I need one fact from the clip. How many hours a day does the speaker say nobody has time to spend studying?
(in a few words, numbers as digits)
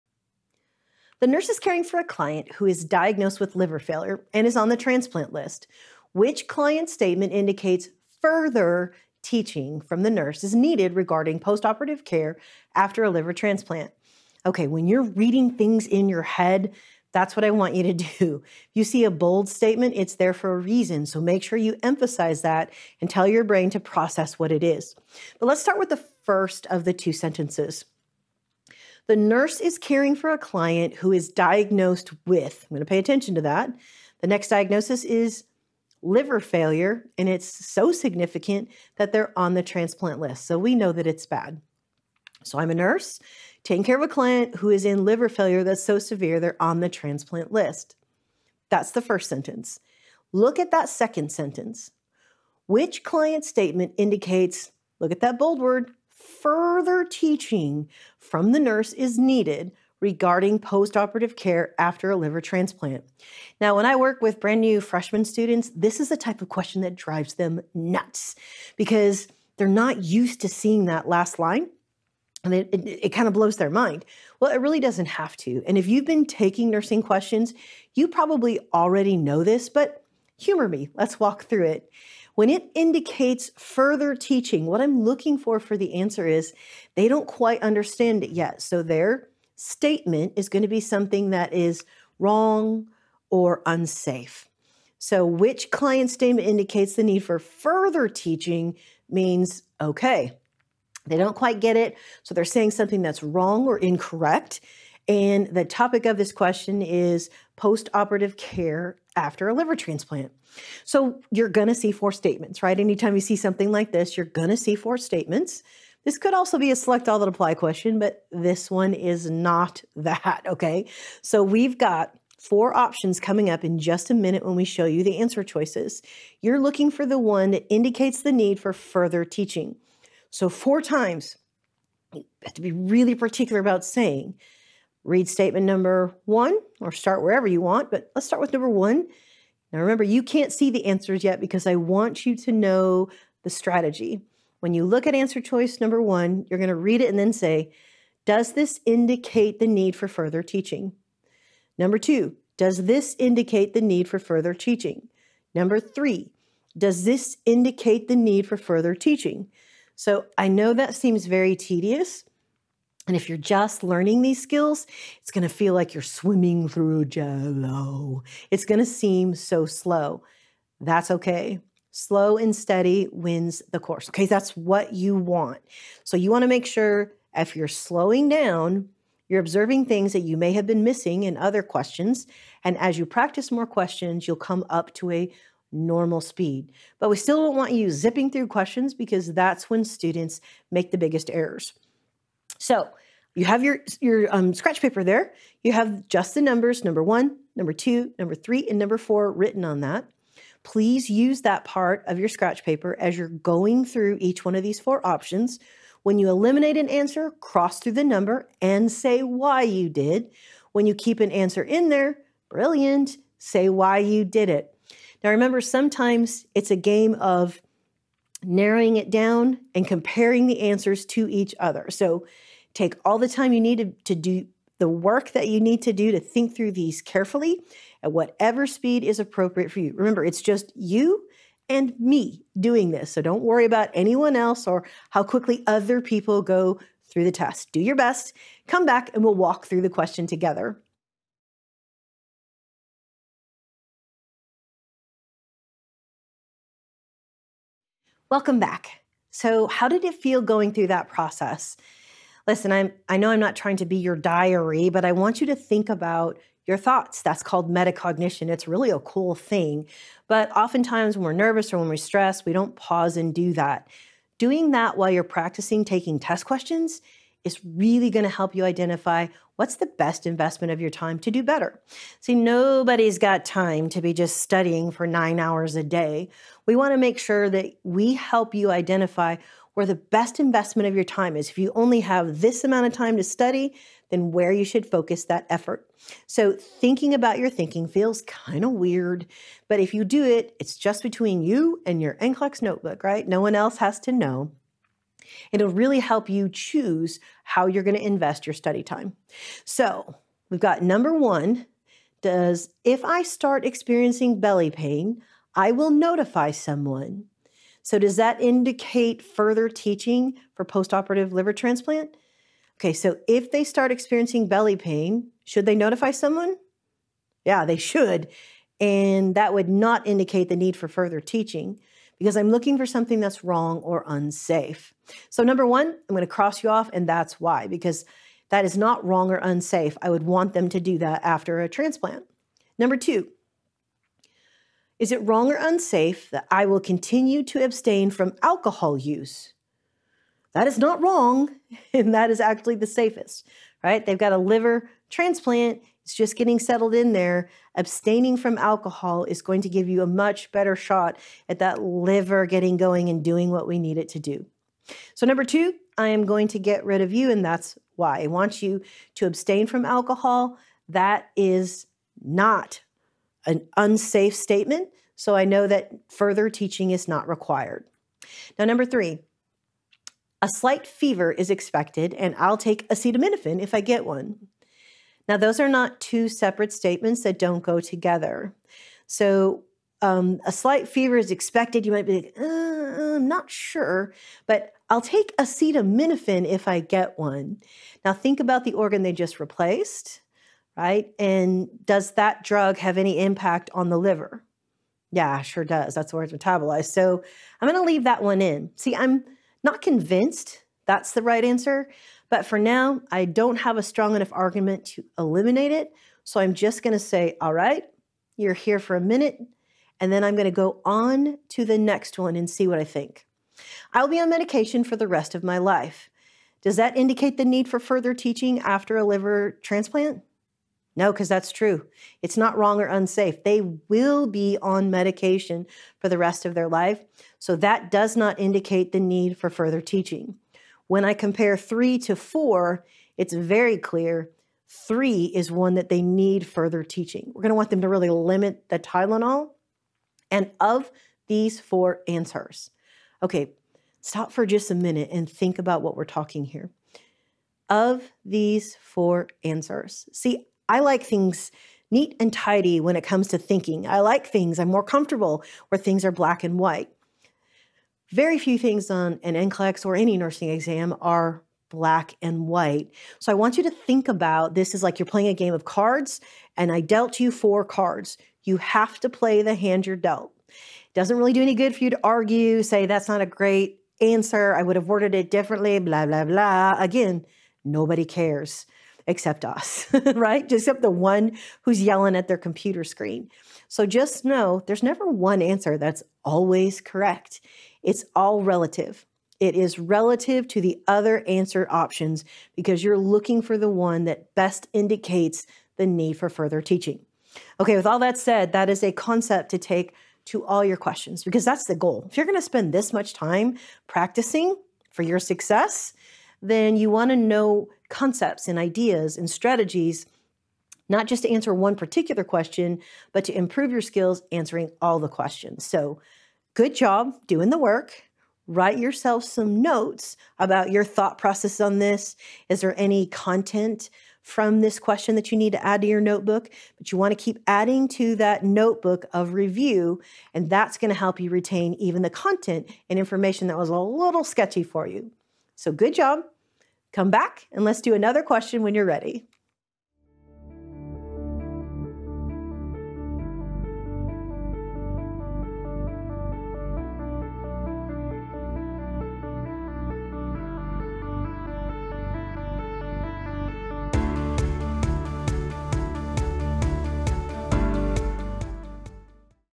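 9.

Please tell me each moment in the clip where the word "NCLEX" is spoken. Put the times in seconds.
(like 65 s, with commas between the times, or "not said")
292 s, 459 s.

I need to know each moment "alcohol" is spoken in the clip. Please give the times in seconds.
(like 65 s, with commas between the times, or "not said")
338 s, 348 s, 359 s.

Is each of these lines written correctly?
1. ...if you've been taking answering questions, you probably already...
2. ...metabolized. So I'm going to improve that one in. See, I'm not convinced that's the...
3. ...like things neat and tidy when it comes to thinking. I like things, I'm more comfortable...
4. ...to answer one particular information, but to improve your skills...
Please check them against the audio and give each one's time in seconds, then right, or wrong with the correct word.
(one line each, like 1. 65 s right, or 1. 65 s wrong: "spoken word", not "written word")
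1. 75 s wrong: "nursing", not "answering"
2. 396 s wrong: "leave", not "improve"
3. 450 s right
4. 511 s wrong: "question", not "information".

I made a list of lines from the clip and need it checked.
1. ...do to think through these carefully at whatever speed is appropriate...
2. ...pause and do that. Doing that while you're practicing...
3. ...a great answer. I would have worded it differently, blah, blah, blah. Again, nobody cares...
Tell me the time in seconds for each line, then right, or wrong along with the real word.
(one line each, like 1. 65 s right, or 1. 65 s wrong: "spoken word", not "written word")
1. 225 s right
2. 262 s right
3. 473 s right.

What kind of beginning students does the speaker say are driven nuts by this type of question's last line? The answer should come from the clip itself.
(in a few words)
Freshman students.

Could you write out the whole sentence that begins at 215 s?
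Now remember, sometimes it's a game of narrowing it down and comparing the answers to each other.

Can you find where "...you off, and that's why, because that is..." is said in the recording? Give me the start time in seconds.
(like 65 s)
326 s.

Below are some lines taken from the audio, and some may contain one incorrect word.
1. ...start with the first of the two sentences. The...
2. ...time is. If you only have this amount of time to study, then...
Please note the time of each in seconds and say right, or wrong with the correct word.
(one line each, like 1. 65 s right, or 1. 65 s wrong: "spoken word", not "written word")
1. 25 s right
2. 281 s right.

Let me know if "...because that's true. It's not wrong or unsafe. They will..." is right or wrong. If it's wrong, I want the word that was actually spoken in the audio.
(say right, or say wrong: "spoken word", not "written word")
right.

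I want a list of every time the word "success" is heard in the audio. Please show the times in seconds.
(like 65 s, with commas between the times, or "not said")
505 s.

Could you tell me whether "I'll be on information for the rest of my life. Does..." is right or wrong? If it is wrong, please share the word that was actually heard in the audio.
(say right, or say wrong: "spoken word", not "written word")
wrong: "medication", not "information".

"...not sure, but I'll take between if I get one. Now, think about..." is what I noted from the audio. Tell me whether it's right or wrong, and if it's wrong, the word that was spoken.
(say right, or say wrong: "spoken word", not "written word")
wrong: "acetaminophen", not "between".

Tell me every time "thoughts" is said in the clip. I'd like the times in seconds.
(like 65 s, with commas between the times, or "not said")
256 s, 520 s.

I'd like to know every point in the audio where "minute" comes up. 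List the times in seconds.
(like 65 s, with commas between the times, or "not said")
124 s, 409 s, 444 s.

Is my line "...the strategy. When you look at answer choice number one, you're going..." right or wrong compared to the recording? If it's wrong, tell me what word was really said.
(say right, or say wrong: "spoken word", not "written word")
right.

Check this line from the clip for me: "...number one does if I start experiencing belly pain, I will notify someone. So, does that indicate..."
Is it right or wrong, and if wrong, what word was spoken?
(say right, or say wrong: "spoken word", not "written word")
right.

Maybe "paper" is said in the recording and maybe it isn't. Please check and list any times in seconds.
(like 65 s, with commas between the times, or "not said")
194 s, 202 s.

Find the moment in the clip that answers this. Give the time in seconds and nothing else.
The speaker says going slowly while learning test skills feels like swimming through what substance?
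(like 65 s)
167 s.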